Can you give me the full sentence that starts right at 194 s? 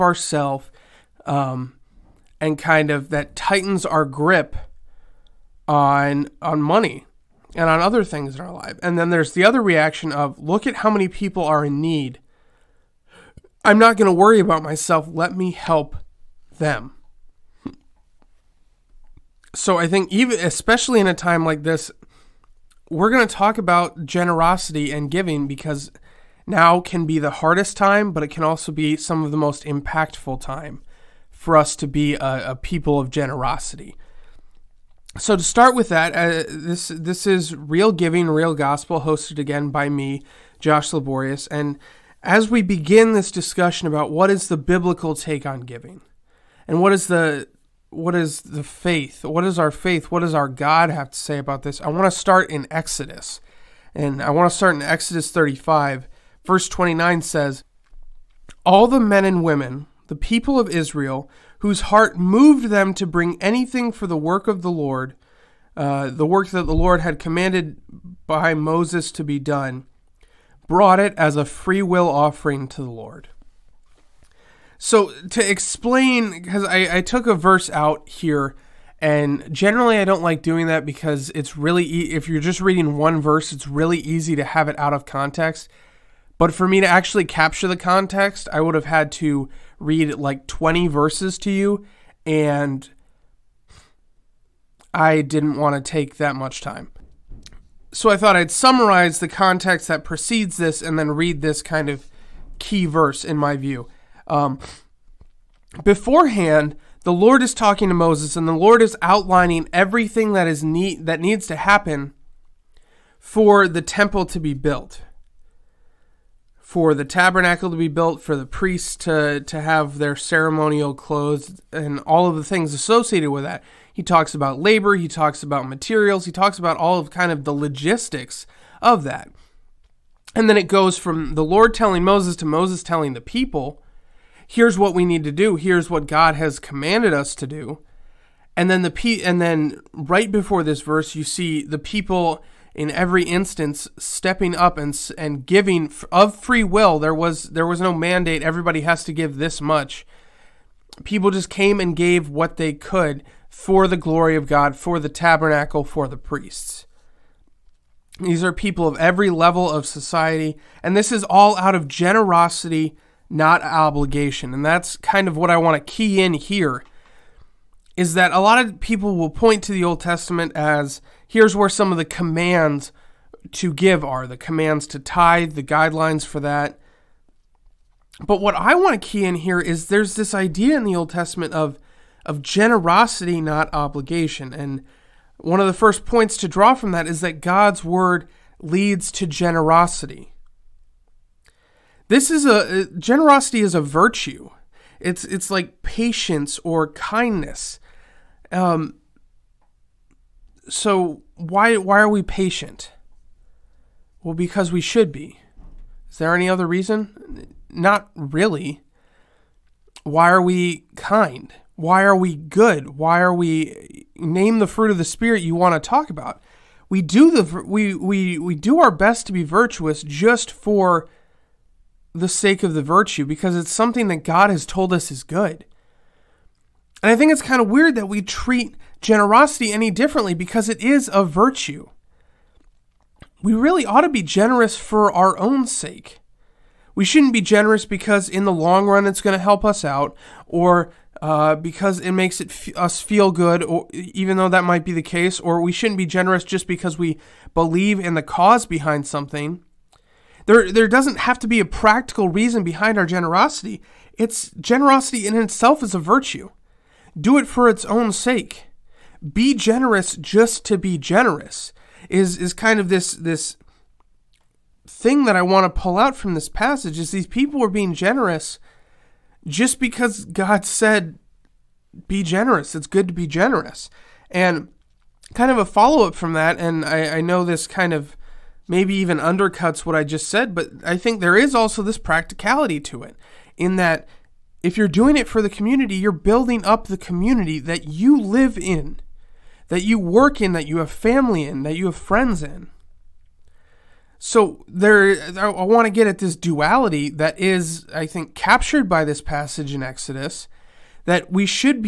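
It's it's like patience or kindness.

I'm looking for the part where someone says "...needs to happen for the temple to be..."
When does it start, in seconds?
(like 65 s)
111 s.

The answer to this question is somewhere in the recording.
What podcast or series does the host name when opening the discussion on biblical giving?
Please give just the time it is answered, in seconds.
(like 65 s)
37 s.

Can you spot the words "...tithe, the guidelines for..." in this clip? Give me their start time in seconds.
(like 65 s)
174 s.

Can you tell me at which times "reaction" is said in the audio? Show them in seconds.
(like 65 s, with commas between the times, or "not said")
9 s.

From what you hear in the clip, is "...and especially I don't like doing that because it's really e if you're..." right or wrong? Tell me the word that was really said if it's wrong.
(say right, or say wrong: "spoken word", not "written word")
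wrong: "generally", not "especially".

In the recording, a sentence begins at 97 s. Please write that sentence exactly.
So I thought I'd summarize the context that precedes this and then read this kind of key verse in my view.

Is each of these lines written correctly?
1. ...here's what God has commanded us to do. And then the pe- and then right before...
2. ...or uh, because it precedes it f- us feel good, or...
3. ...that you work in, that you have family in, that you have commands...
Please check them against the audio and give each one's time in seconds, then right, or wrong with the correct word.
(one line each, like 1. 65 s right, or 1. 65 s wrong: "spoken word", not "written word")
1. 135 s right
2. 240 s wrong: "makes", not "precedes"
3. 289 s wrong: "friends", not "commands".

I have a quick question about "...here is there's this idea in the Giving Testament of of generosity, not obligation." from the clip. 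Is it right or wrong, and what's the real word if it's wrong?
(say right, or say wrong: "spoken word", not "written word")
wrong: "Old", not "Giving".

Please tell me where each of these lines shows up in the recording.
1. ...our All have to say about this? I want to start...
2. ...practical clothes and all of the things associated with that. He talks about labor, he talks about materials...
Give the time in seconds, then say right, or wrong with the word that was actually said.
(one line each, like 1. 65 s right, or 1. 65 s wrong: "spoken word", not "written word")
1. 50 s wrong: "God", not "All"
2. 120 s wrong: "ceremonial", not "practical".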